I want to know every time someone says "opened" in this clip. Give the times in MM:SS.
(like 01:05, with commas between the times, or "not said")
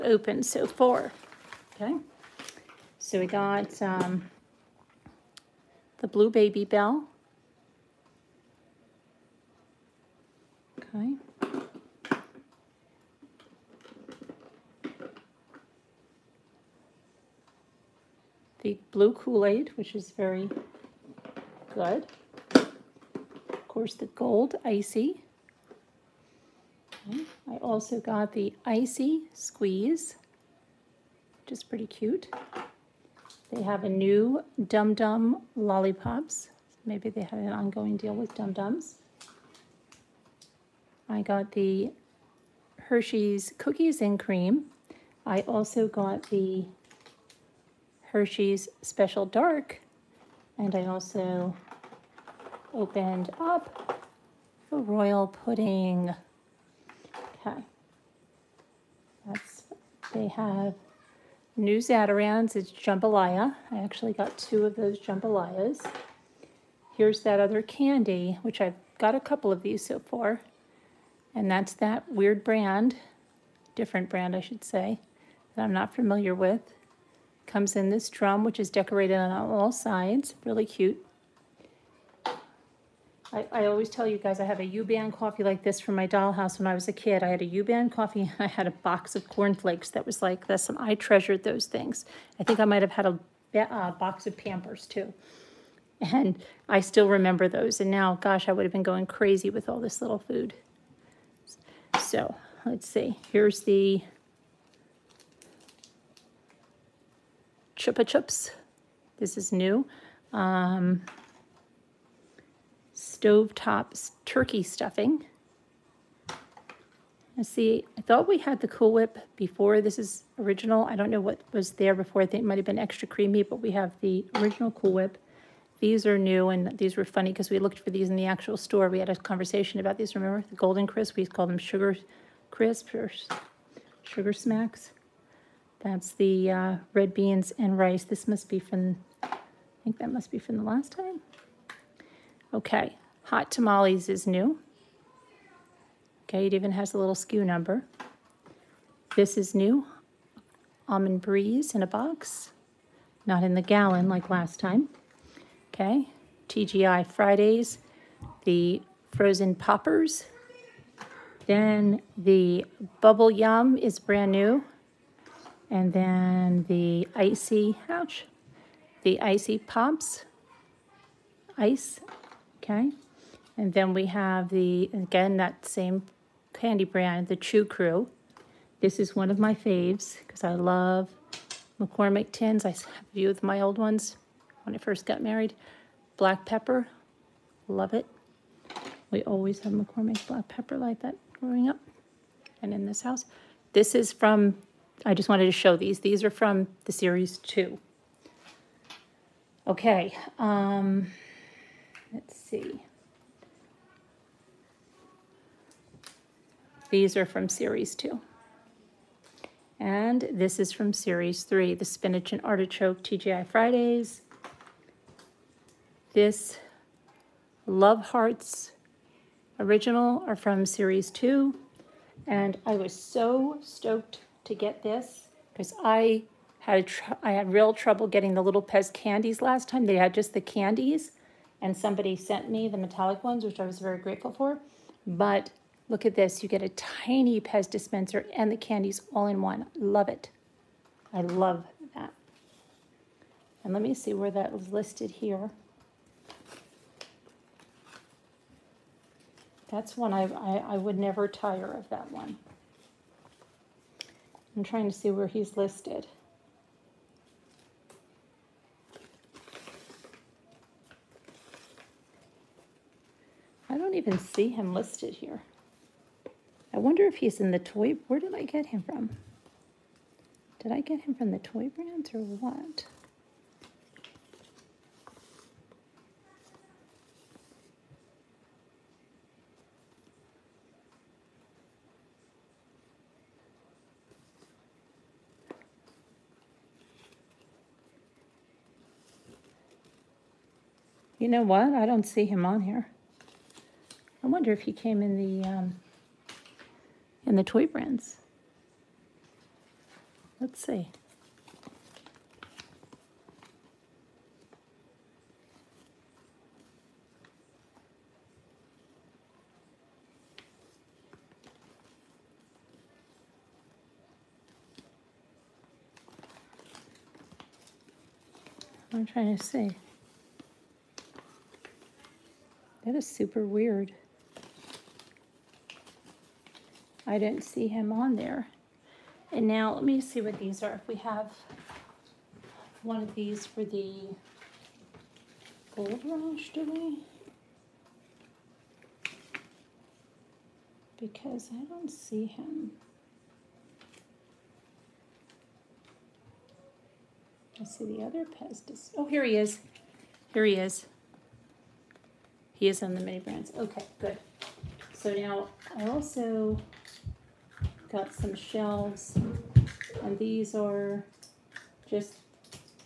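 00:00, 00:52.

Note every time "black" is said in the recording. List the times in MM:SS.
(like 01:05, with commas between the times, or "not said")
03:06, 03:10.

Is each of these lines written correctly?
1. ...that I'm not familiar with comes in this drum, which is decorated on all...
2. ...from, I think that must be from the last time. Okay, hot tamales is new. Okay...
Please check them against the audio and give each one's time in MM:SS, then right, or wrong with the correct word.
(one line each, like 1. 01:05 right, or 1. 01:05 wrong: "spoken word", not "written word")
1. 01:15 right
2. 02:18 right.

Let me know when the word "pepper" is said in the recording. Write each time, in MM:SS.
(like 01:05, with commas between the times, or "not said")
03:06, 03:10.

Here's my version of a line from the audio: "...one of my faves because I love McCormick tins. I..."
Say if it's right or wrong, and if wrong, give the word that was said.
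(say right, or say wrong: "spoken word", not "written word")
right.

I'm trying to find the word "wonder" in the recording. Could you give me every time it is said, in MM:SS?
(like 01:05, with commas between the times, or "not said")
04:26, 04:54.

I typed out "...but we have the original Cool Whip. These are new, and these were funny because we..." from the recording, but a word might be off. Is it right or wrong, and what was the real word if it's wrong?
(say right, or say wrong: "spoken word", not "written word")
right.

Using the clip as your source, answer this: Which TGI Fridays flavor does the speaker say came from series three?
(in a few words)
Spinach and artichoke.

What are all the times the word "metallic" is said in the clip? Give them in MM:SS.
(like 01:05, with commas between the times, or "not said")
03:52.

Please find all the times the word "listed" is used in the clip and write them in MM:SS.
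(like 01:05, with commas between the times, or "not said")
04:04, 04:15, 04:24.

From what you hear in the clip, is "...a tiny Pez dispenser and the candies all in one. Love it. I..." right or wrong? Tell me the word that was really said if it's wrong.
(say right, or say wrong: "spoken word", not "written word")
right.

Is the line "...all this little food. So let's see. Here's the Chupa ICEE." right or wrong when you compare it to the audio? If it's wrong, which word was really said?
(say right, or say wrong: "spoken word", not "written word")
wrong: "Chups", not "ICEE".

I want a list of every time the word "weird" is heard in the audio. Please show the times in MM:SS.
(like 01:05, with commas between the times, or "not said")
01:12, 05:23.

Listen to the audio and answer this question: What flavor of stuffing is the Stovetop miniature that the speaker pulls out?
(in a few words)
Turkey.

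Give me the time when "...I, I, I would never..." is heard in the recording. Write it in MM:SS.
04:10.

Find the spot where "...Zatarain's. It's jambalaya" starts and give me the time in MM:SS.
01:01.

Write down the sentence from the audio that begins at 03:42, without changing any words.
And I was so stoked to get this because I had I had real trouble getting the little Pez candies last time.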